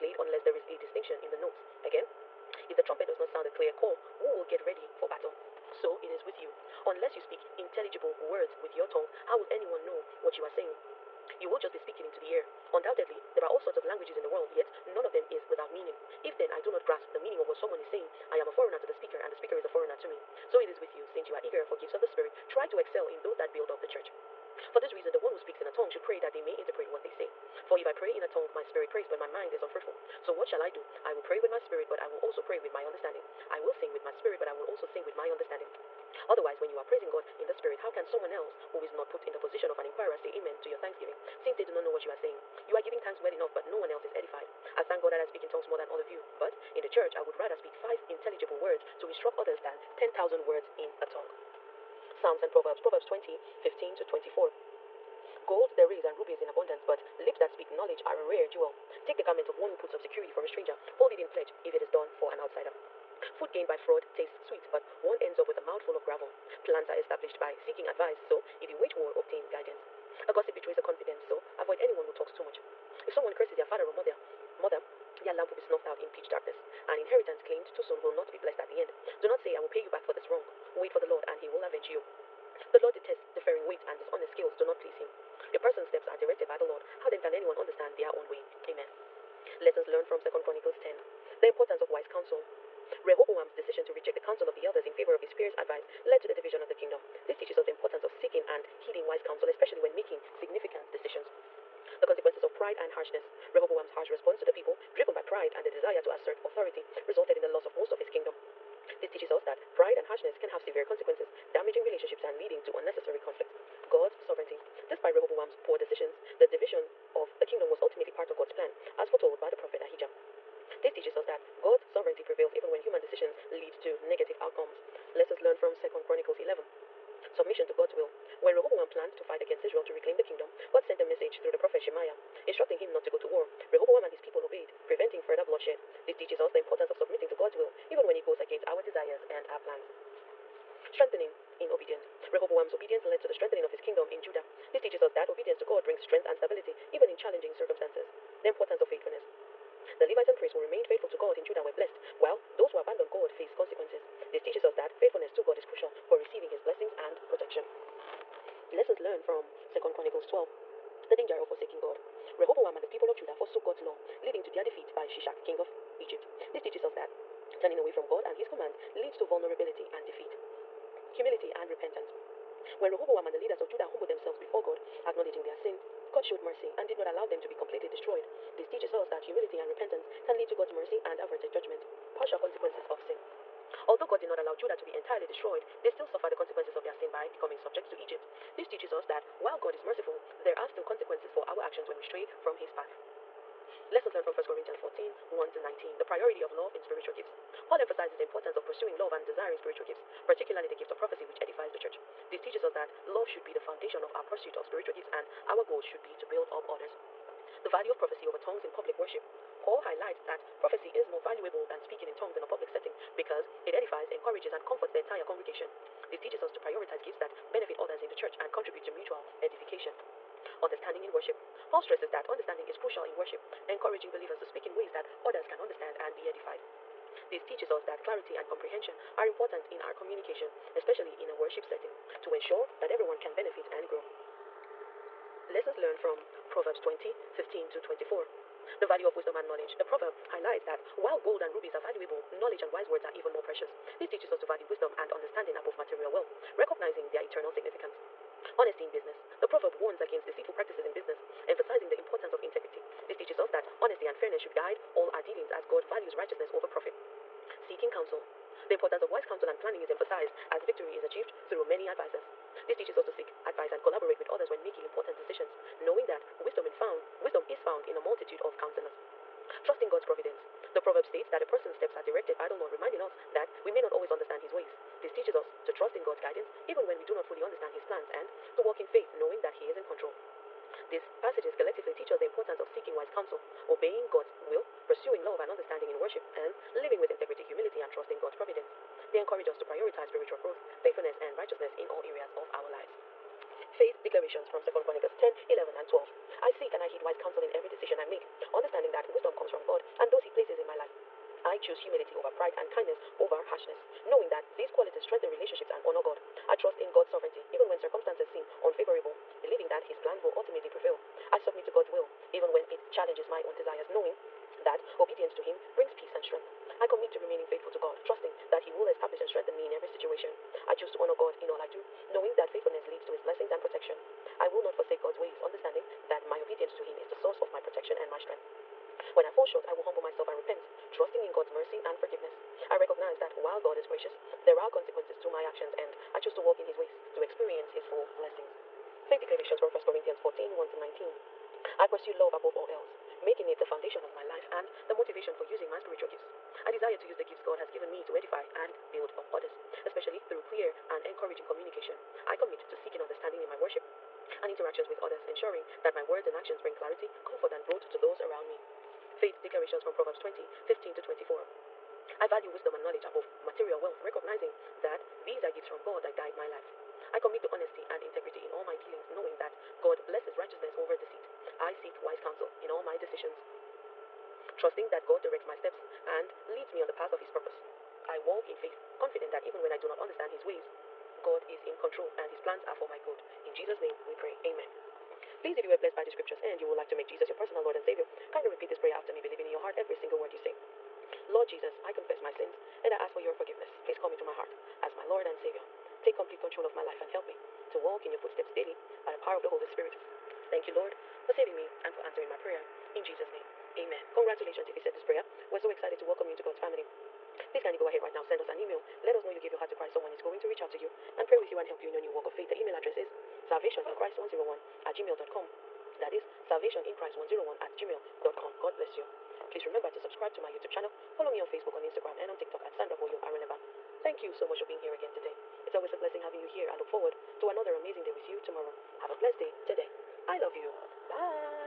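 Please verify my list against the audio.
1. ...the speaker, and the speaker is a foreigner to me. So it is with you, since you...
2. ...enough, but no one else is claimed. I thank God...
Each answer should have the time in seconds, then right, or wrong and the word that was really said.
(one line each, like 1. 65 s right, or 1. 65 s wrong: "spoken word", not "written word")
1. 18 s right
2. 43 s wrong: "edified", not "claimed".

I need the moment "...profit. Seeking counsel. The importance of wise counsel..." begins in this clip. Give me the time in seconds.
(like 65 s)
256 s.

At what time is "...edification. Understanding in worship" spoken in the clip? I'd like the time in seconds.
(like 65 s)
219 s.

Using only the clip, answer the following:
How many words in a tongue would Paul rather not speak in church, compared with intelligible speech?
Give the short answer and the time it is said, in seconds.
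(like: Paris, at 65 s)
10,000, at 49 s.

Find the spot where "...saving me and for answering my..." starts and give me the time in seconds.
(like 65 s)
401 s.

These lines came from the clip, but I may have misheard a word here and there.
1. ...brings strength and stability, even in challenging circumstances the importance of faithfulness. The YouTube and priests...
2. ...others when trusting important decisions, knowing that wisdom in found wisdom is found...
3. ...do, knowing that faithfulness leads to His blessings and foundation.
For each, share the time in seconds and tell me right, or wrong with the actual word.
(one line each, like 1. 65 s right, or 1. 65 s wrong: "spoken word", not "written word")
1. 145 s wrong: "Levites", not "YouTube"
2. 264 s wrong: "making", not "trusting"
3. 321 s wrong: "protection", not "foundation".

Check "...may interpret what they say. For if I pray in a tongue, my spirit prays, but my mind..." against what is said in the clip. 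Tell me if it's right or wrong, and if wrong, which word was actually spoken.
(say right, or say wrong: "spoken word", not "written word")
right.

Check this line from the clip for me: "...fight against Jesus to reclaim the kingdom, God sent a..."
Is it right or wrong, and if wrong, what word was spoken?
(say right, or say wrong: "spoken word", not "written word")
wrong: "Israel", not "Jesus".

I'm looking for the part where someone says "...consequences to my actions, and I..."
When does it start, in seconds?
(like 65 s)
334 s.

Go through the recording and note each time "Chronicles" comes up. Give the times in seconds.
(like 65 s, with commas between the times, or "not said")
90 s, 126 s, 159 s, 294 s.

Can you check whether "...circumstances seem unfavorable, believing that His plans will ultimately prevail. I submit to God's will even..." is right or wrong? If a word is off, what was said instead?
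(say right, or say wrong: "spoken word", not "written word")
right.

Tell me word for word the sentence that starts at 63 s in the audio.
Food gained by fraud tastes sweet, but one ends up with a mouthful of gravel.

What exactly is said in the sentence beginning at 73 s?
If someone curses their father or mother, mother, their lamp will be snuffed out in pitch darkness.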